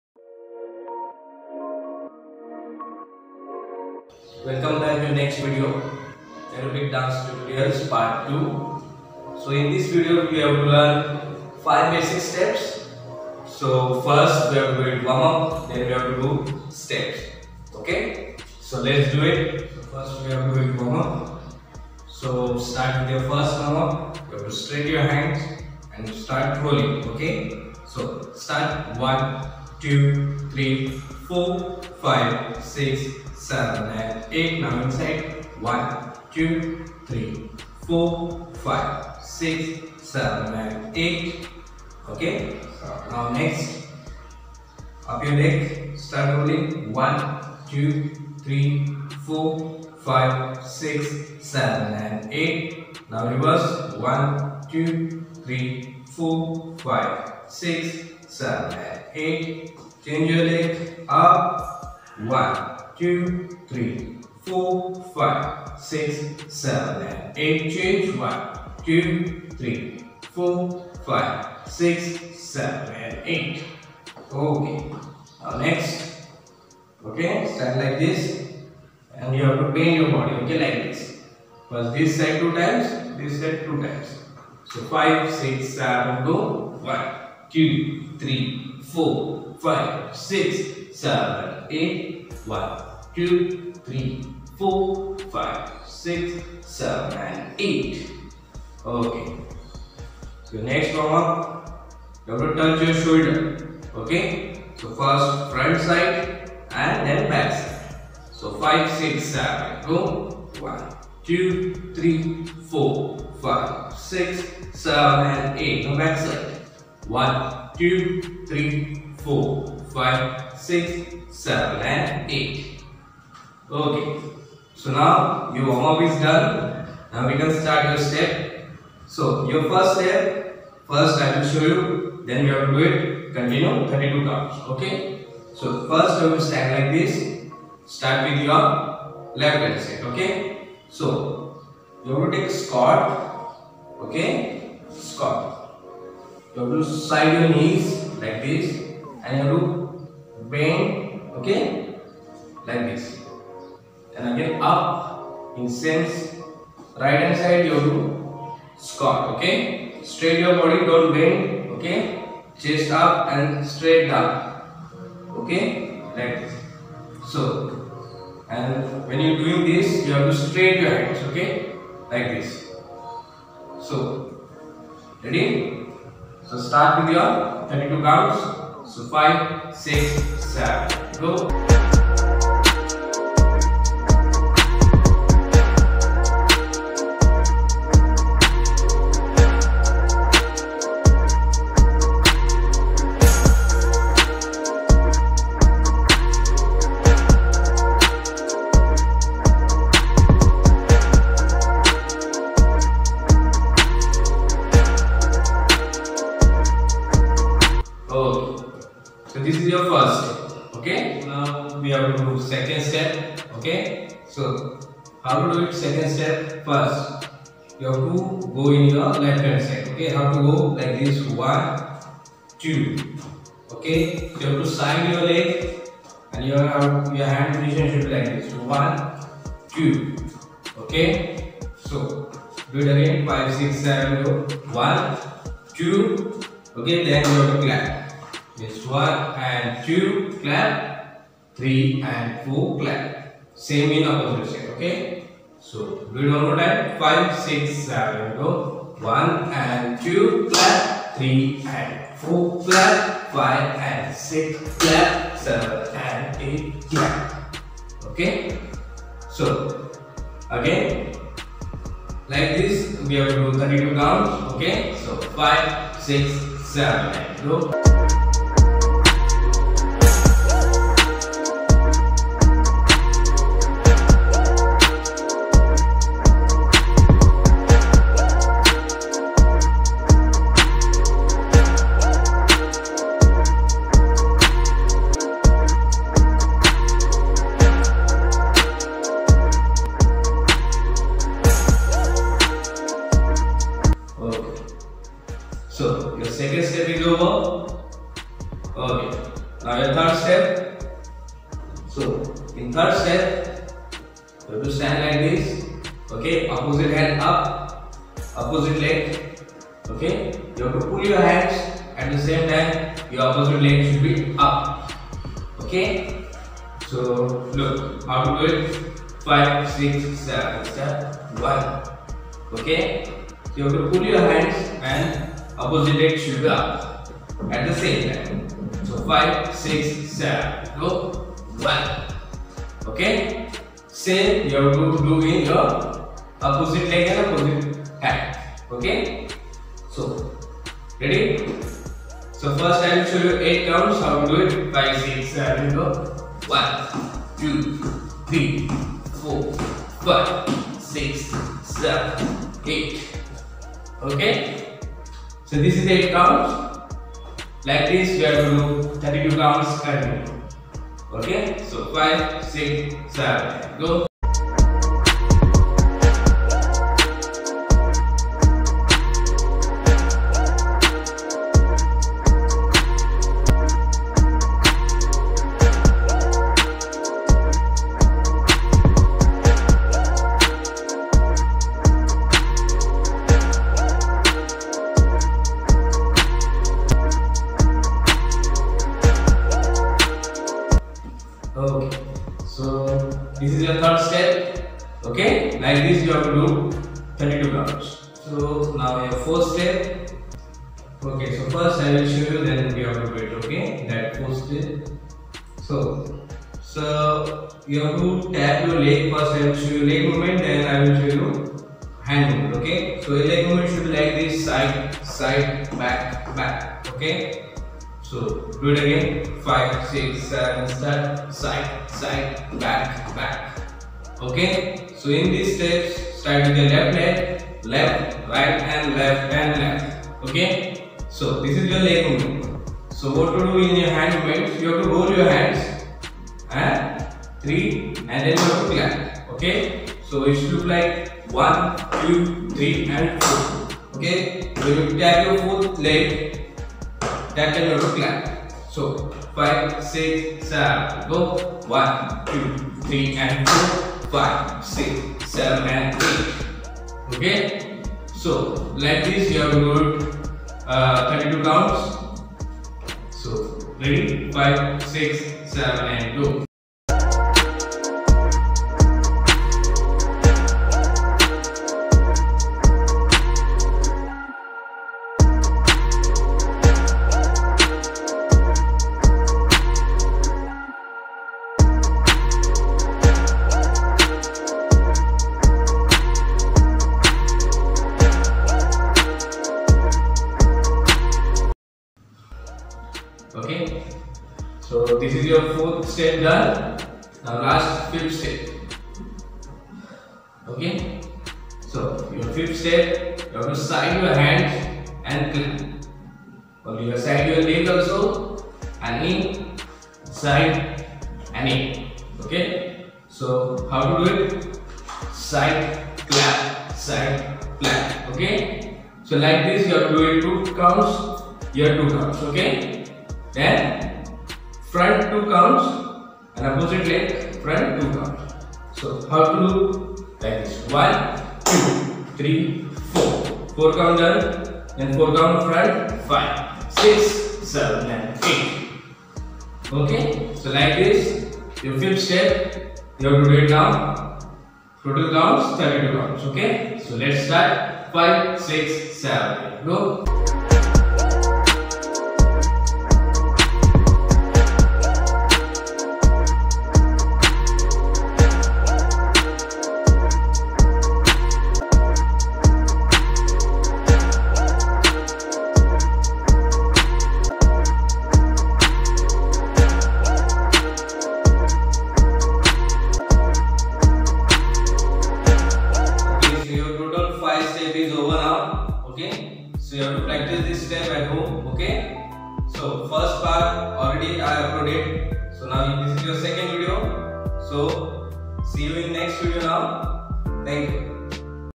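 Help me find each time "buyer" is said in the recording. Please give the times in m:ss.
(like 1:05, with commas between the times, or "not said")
not said.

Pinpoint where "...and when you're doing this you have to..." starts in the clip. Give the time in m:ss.
2:48.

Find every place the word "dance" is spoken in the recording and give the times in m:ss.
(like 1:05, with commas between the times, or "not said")
0:06.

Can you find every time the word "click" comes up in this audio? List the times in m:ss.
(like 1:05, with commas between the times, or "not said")
8:25.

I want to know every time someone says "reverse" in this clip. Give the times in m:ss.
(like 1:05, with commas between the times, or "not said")
0:53.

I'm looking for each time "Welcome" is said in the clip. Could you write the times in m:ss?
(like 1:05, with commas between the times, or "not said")
0:04.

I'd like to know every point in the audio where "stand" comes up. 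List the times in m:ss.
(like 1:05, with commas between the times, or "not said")
1:17, 2:16, 5:04.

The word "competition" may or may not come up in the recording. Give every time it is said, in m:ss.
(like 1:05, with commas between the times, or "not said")
not said.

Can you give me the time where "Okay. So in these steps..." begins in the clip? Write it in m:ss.
7:04.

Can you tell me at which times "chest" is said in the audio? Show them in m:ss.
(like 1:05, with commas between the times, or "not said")
2:42.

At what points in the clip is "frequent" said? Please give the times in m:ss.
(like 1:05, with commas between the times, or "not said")
not said.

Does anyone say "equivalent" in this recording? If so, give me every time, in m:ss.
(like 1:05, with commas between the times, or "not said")
not said.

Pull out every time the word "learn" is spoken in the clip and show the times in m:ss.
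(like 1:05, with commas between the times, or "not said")
0:10.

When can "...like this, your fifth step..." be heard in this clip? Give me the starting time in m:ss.
9:00.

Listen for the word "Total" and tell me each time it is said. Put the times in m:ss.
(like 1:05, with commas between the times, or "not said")
9:04.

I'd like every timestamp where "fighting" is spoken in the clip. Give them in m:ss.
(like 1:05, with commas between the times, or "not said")
not said.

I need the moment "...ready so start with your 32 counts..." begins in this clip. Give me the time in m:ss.
2:55.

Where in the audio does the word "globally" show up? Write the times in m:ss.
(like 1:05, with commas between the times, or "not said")
not said.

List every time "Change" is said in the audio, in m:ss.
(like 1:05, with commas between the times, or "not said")
1:00, 1:07.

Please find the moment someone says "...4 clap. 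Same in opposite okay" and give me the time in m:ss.
4:02.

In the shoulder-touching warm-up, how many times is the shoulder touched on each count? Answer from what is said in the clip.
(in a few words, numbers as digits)
Double.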